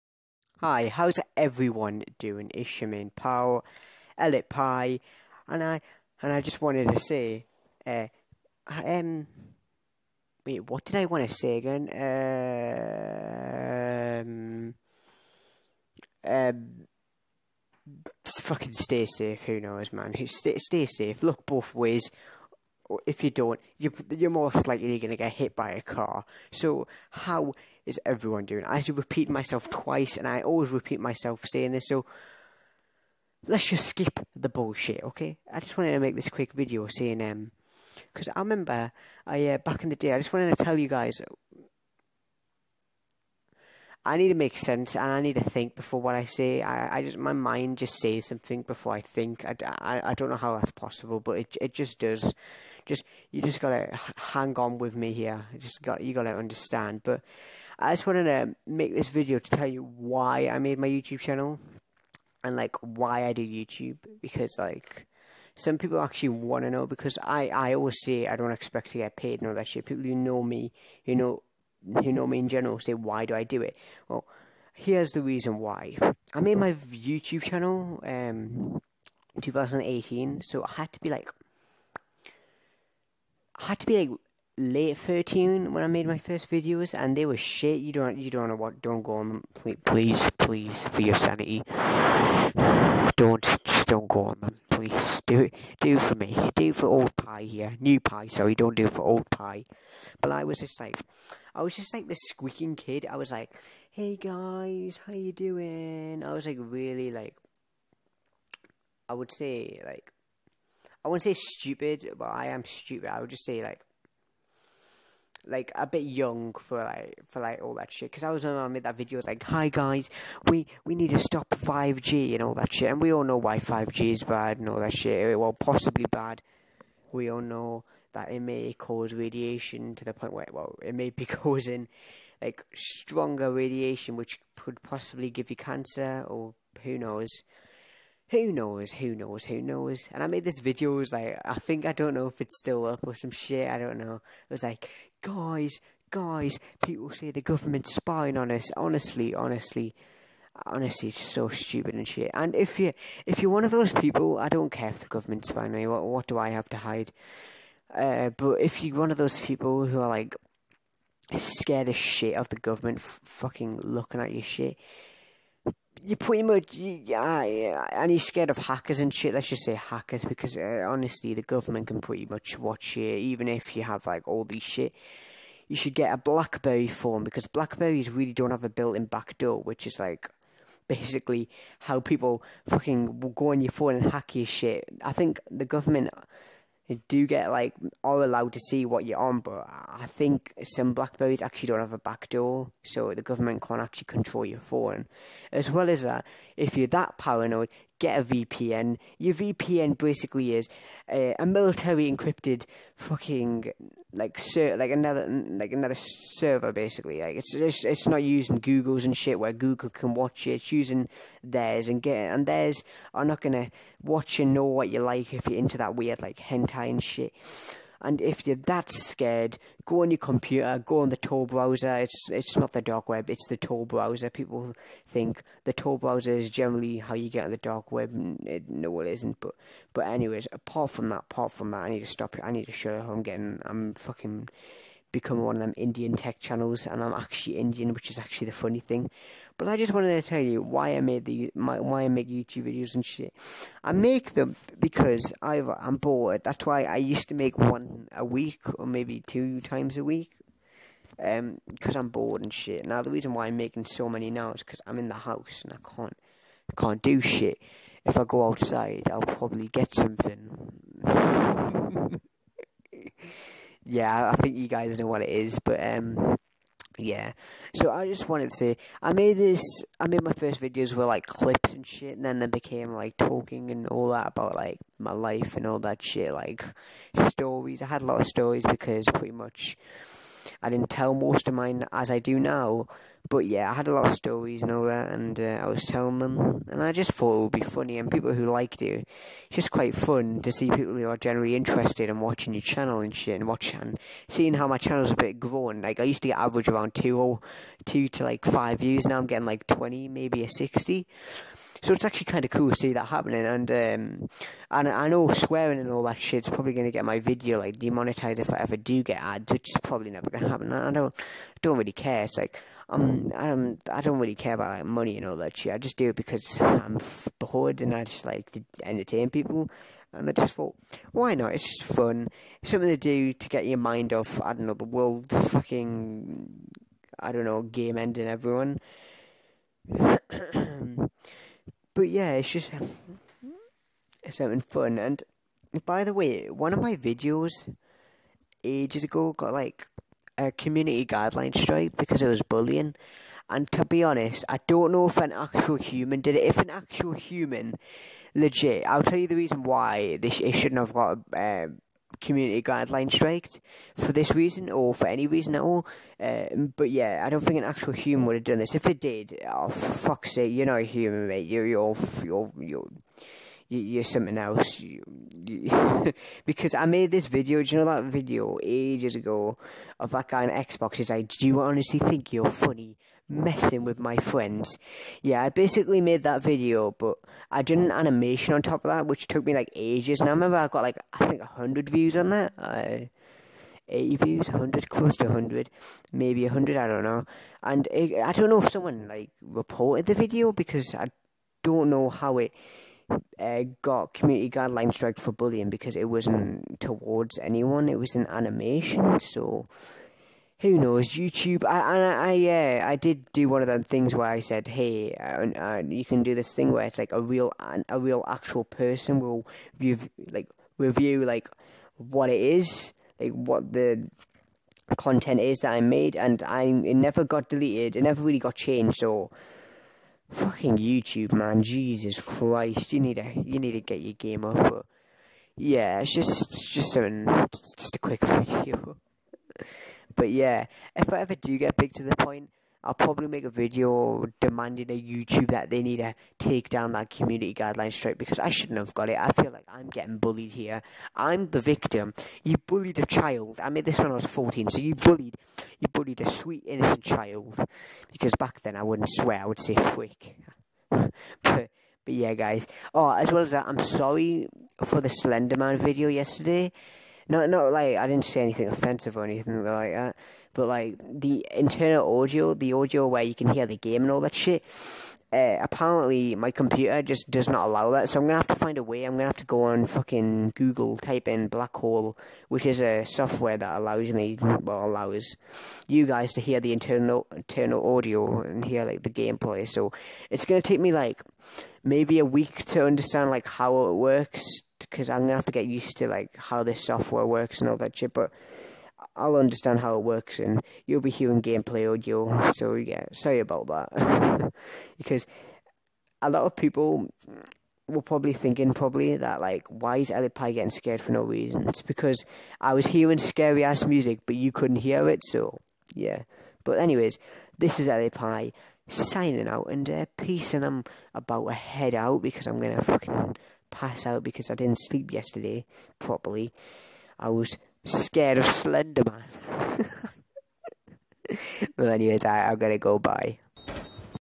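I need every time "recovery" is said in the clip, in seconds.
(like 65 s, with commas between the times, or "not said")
not said.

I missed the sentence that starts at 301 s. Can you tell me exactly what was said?
So it's actually kind of cool to see that happening.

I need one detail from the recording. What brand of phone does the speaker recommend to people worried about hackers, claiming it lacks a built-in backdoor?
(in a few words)
BlackBerry.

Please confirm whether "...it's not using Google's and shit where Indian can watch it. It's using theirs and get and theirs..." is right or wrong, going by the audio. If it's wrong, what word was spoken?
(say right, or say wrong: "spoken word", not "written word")
wrong: "Google", not "Indian".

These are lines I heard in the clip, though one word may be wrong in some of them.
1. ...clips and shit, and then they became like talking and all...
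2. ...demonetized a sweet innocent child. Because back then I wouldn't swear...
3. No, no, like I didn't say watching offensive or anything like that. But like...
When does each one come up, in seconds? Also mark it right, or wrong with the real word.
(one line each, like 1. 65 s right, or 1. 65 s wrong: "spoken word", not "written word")
1. 271 s right
2. 445 s wrong: "bullied", not "demonetized"
3. 457 s wrong: "anything", not "watching".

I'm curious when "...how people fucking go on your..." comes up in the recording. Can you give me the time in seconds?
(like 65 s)
181 s.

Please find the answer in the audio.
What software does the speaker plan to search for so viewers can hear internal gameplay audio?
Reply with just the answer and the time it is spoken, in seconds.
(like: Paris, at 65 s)
BlackHole, at 471 s.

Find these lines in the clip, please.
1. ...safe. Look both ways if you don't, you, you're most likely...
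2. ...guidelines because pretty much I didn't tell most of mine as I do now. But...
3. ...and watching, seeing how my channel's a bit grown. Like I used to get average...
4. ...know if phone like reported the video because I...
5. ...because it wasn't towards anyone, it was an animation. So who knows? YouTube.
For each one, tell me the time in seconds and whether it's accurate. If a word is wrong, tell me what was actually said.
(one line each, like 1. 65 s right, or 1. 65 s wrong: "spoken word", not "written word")
1. 20 s right
2. 278 s wrong: "stories", not "guidelines"
3. 293 s right
4. 388 s wrong: "someone", not "phone"
5. 395 s right.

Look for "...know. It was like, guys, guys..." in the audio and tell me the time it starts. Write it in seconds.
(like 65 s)
143 s.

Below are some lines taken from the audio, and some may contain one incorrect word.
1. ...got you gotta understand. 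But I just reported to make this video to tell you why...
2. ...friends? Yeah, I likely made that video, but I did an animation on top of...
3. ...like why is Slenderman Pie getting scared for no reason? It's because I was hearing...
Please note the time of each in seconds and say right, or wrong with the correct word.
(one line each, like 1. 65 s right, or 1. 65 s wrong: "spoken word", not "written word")
1. 55 s wrong: "wanted", not "reported"
2. 374 s wrong: "basically", not "likely"
3. 499 s wrong: "Ellie", not "Slenderman".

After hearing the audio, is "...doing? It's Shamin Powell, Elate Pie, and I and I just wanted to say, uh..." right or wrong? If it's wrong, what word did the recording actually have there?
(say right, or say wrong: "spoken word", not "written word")
right.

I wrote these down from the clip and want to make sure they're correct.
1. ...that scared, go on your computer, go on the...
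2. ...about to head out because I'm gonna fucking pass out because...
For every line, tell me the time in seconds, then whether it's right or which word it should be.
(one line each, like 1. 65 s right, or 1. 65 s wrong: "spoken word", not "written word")
1. 218 s right
2. 511 s right.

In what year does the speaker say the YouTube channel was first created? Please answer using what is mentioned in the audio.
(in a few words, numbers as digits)
2018.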